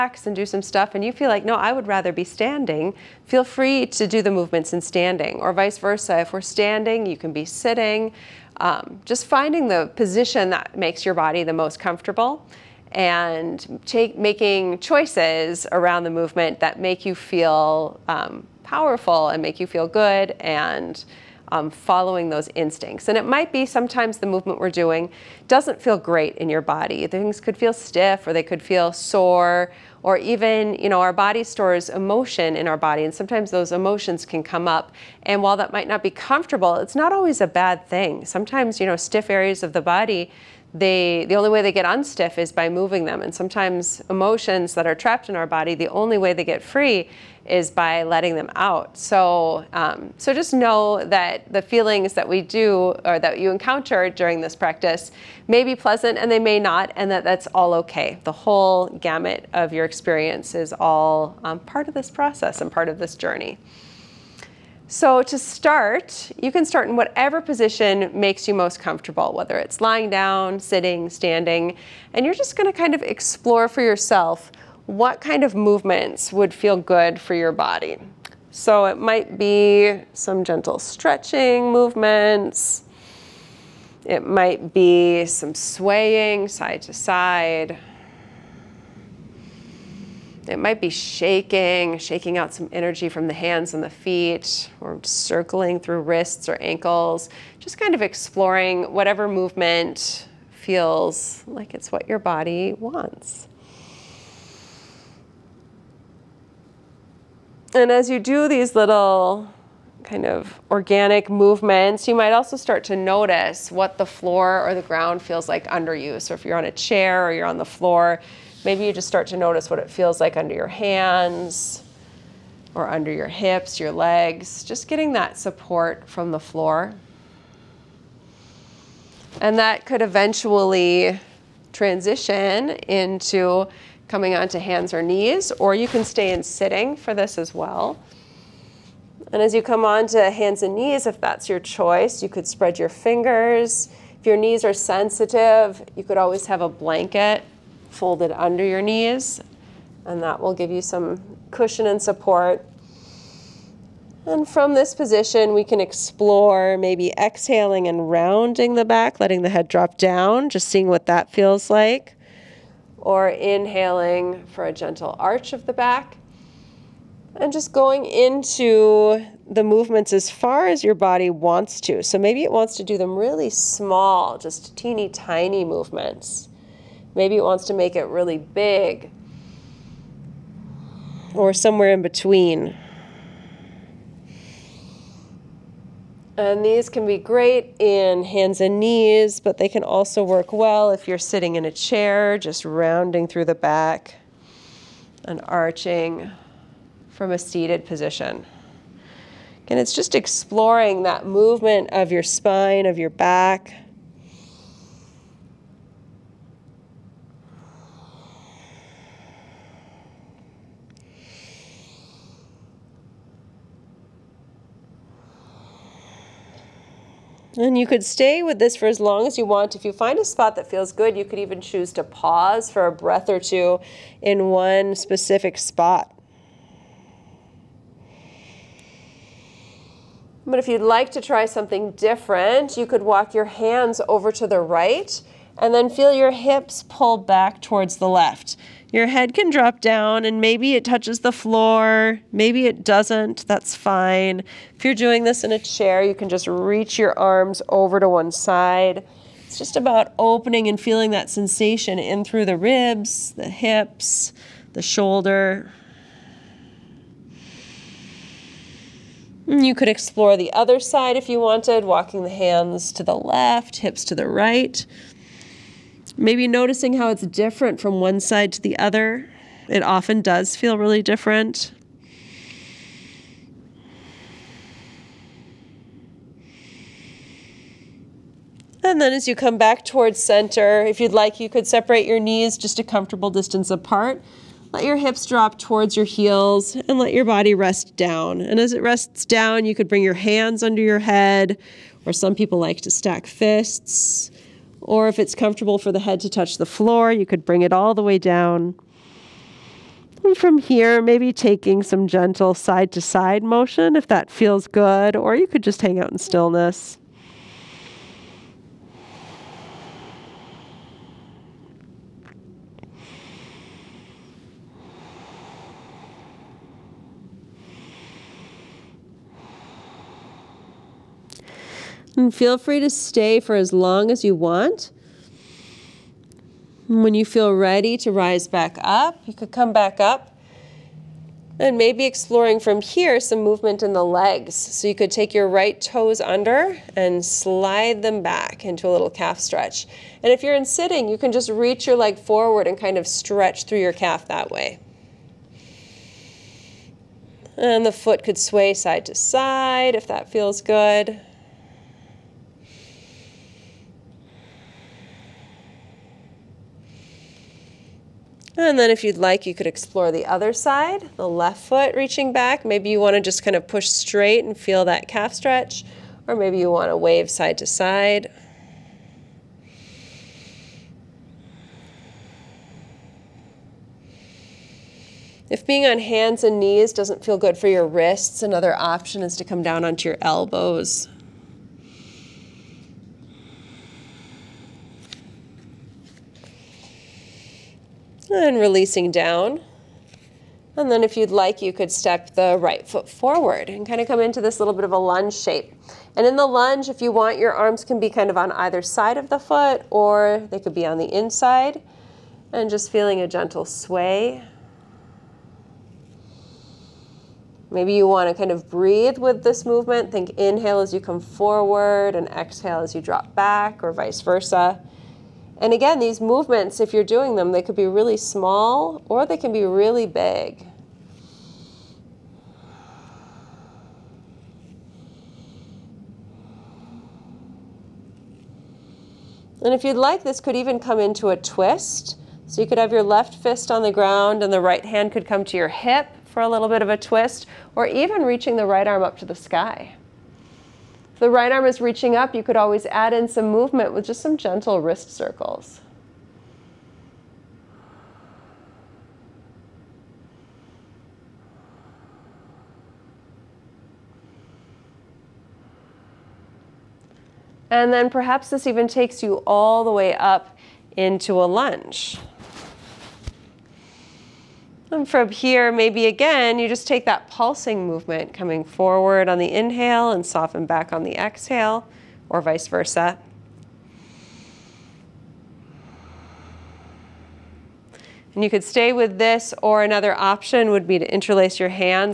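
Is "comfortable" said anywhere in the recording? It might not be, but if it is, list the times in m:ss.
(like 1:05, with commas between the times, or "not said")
0:11, 0:36, 1:08, 4:42, 4:55.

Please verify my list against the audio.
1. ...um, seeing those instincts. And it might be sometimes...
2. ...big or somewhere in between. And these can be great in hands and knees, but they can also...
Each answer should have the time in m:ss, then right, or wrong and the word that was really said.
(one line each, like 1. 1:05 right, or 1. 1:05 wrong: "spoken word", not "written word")
1. 0:21 wrong: "following", not "seeing"
2. 2:58 right.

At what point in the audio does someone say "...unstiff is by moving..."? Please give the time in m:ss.
0:41.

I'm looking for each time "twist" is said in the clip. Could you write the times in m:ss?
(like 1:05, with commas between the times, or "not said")
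7:11, 7:16.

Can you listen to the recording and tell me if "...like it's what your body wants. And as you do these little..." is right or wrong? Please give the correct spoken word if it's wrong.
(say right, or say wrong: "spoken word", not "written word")
right.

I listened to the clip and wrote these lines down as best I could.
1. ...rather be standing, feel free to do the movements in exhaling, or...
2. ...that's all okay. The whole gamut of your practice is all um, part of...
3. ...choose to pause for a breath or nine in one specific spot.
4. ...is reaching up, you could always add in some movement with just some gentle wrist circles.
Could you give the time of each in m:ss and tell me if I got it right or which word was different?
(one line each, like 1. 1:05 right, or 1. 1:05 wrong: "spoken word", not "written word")
1. 0:01 wrong: "standing", not "exhaling"
2. 0:57 wrong: "experience", not "practice"
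3. 3:41 wrong: "two", not "nine"
4. 7:21 right.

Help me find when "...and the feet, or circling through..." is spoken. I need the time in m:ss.
1:33.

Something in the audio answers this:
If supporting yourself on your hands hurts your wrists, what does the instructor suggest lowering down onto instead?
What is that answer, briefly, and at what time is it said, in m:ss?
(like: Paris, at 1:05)
elbows, at 6:20.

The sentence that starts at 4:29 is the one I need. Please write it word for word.
It often does feel really different.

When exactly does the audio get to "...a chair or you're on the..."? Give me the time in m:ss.
1:56.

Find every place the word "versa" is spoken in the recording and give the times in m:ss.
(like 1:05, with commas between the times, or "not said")
0:05, 6:54, 7:52.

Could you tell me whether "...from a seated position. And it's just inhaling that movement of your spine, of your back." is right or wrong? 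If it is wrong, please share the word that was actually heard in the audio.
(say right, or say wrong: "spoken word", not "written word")
wrong: "exploring", not "inhaling".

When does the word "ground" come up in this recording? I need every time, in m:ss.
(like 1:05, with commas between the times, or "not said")
1:54, 7:13.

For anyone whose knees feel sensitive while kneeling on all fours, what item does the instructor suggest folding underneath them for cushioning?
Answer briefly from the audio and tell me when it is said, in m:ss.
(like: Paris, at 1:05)
a blanket, at 2:26.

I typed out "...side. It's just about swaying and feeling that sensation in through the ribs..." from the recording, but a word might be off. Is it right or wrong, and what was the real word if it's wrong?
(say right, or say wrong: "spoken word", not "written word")
wrong: "opening", not "swaying".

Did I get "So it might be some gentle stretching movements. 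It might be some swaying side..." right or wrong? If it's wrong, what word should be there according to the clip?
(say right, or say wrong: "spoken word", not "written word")
right.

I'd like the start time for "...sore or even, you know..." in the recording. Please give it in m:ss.
0:28.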